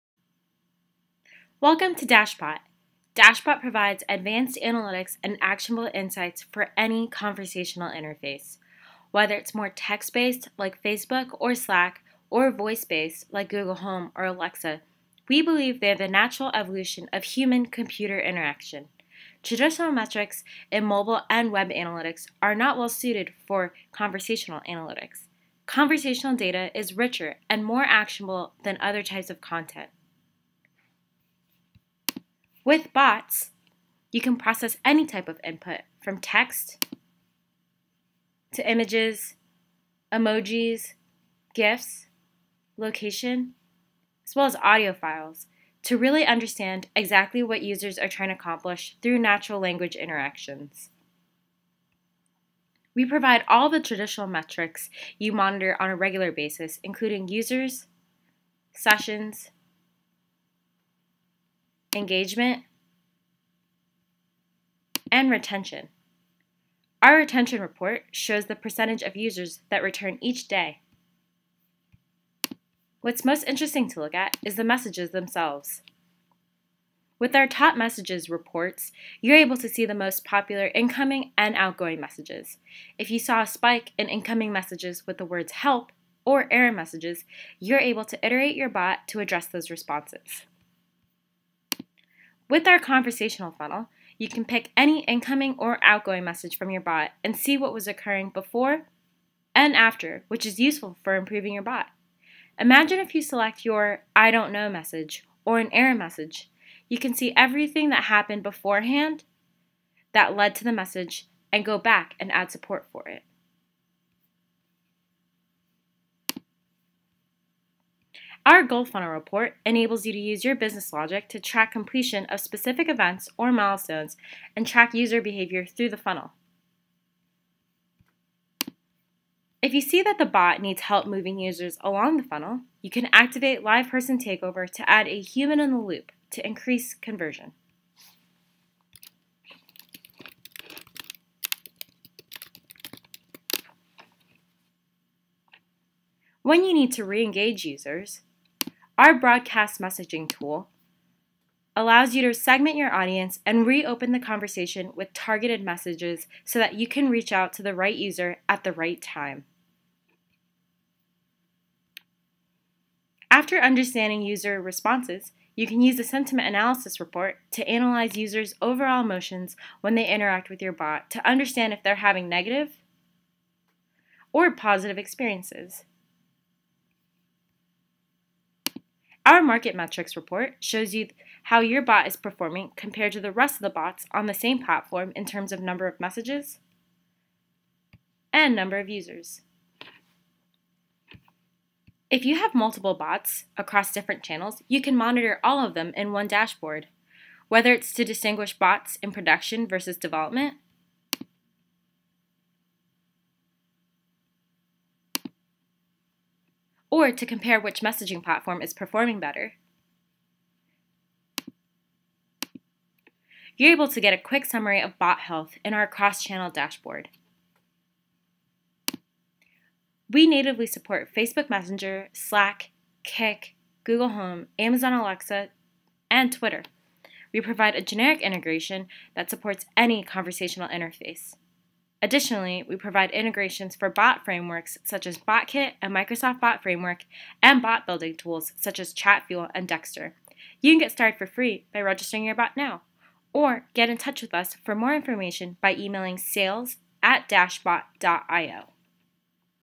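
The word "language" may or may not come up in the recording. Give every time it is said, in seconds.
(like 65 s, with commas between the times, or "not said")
49 s.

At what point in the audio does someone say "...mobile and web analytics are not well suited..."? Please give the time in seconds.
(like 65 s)
20 s.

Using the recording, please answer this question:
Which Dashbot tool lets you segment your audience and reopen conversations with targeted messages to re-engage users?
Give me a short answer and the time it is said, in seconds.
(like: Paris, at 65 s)
Broadcast messaging tool, at 149 s.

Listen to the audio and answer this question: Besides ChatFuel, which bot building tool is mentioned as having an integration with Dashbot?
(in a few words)
Dexter.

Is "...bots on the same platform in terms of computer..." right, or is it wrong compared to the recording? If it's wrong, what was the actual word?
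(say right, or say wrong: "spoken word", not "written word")
wrong: "number", not "computer".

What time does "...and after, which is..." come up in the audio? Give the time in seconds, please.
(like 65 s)
99 s.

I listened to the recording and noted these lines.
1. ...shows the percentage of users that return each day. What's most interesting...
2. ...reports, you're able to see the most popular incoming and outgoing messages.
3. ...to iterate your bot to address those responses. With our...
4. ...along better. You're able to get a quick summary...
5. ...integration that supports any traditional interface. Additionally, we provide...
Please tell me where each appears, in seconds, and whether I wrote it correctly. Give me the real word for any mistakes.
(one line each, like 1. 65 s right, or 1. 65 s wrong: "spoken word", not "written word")
1. 68 s right
2. 78 s right
3. 88 s right
4. 208 s wrong: "performing", not "along"
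5. 228 s wrong: "conversational", not "traditional".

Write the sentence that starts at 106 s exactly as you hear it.
You can see everything that happened beforehand that led to the message and go back and add support for it.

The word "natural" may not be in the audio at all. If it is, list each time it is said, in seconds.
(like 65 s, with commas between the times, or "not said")
16 s, 49 s.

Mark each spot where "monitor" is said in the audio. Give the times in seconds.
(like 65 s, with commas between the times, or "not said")
55 s, 194 s.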